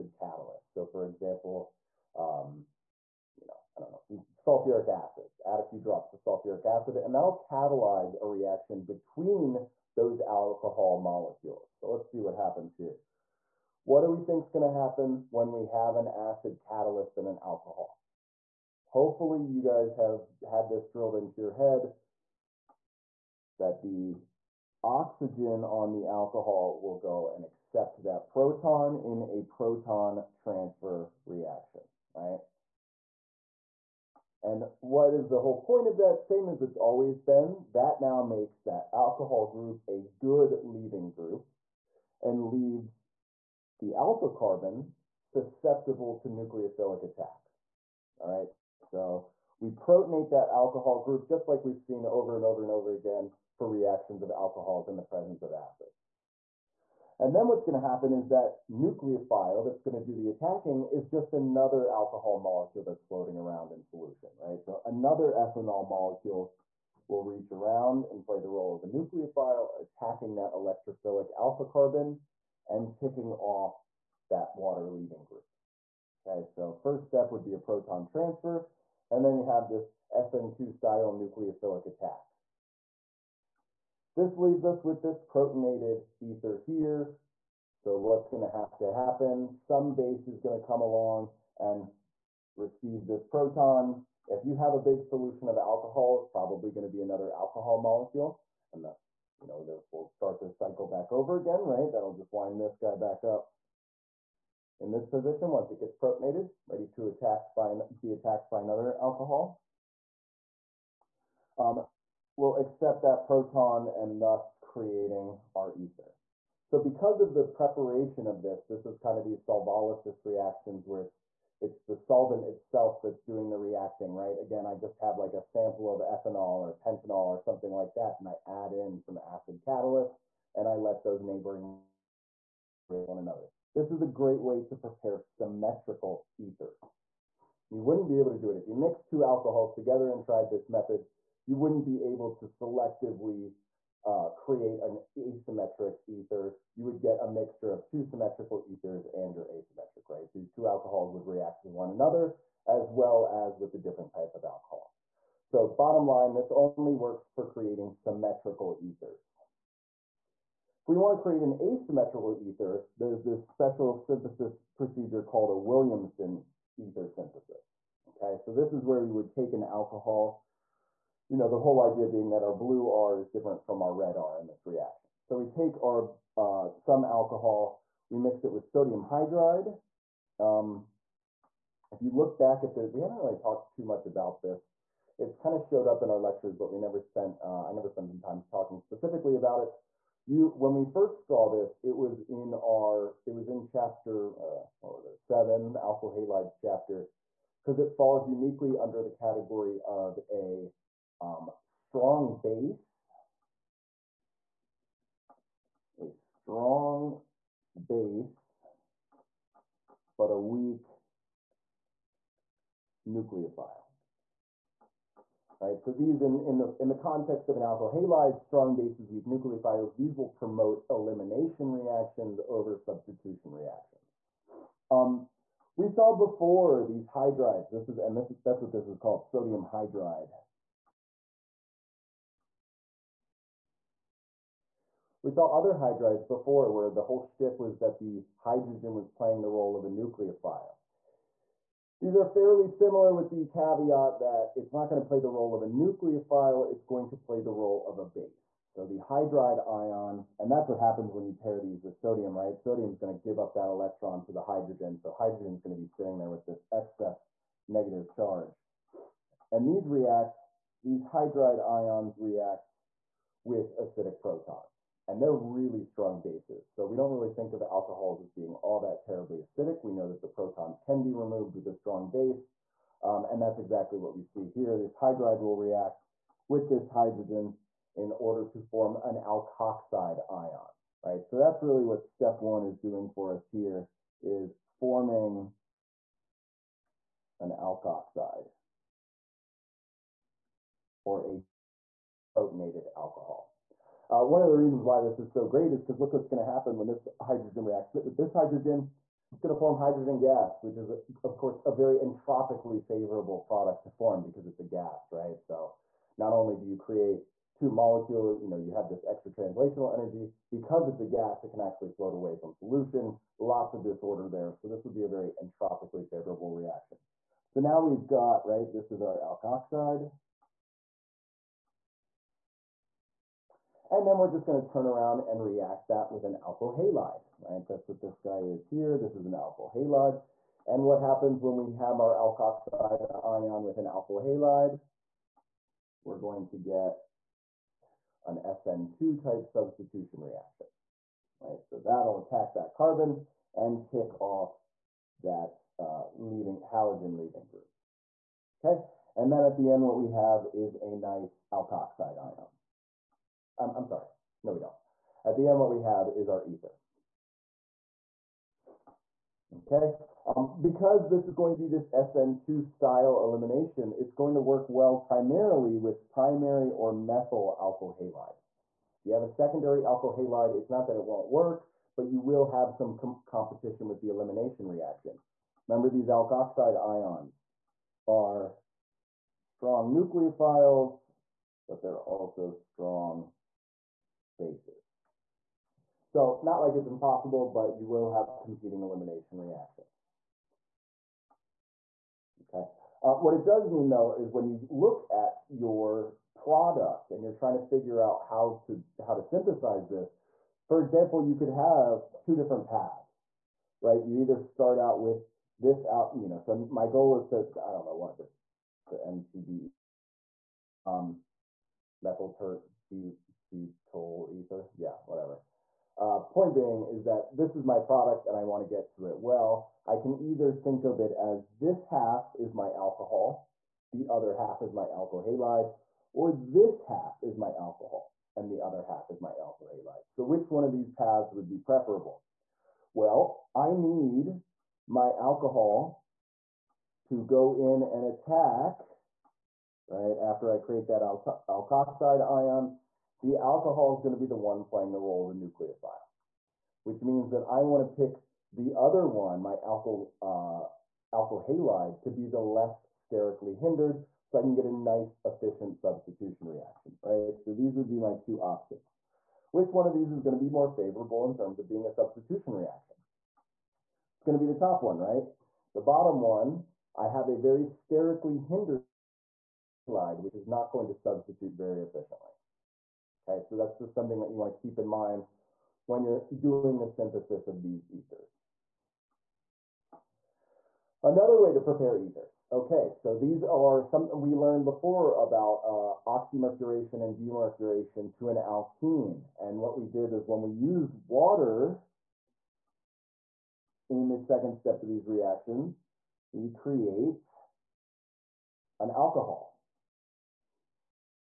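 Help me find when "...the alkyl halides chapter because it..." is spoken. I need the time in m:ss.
3:15.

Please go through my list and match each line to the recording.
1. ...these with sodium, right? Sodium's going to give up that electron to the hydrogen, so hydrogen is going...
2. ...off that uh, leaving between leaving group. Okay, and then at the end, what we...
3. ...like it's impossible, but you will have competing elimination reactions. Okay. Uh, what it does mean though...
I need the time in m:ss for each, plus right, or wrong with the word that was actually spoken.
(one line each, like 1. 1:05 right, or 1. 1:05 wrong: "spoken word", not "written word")
1. 4:11 right
2. 5:44 wrong: "halogen", not "between"
3. 6:26 right.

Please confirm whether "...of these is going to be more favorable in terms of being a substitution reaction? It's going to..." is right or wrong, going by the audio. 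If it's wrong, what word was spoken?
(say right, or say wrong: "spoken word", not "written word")
right.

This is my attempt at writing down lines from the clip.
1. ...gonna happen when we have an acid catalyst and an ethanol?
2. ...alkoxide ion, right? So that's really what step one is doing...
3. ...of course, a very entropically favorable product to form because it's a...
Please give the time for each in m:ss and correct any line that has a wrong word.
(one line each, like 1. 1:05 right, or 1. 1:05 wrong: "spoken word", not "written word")
1. 0:14 wrong: "alcohol", not "ethanol"
2. 4:39 right
3. 5:00 right.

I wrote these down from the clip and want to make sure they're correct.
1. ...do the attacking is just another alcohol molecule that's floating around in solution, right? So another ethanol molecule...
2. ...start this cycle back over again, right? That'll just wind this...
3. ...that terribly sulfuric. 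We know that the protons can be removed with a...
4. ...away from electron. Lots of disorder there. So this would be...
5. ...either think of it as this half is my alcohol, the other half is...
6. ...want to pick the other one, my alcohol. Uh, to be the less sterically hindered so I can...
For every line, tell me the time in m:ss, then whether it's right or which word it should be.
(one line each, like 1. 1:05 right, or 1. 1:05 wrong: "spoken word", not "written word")
1. 1:00 right
2. 1:40 right
3. 4:28 wrong: "acidic", not "sulfuric"
4. 5:12 wrong: "solution", not "electron"
5. 7:00 right
6. 7:27 right.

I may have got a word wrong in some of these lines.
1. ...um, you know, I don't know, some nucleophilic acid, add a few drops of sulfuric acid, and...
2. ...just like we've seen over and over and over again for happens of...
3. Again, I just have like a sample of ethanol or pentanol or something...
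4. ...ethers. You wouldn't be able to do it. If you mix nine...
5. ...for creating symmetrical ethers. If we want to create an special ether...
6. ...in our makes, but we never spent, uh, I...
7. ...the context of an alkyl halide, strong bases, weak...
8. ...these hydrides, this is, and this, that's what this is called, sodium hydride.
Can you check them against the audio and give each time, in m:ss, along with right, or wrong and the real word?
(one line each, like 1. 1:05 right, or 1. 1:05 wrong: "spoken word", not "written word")
1. 0:02 wrong: "sulfuric", not "nucleophilic"
2. 0:51 wrong: "reactions", not "happens"
3. 2:04 right
4. 2:16 wrong: "two", not "nine"
5. 2:37 wrong: "asymmetrical", not "special"
6. 3:06 wrong: "lectures", not "makes"
7. 3:36 right
8. 3:46 right.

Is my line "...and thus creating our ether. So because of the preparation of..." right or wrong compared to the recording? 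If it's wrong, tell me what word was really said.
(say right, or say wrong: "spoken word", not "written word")
right.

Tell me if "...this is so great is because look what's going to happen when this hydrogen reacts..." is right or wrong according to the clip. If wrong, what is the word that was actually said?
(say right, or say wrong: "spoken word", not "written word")
right.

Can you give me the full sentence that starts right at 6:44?
You either start out with this out, you know.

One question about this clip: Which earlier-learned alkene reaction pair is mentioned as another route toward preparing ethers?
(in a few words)
oxymercuration and demercuration.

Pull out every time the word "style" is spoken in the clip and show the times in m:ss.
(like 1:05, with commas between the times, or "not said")
1:20, 6:02.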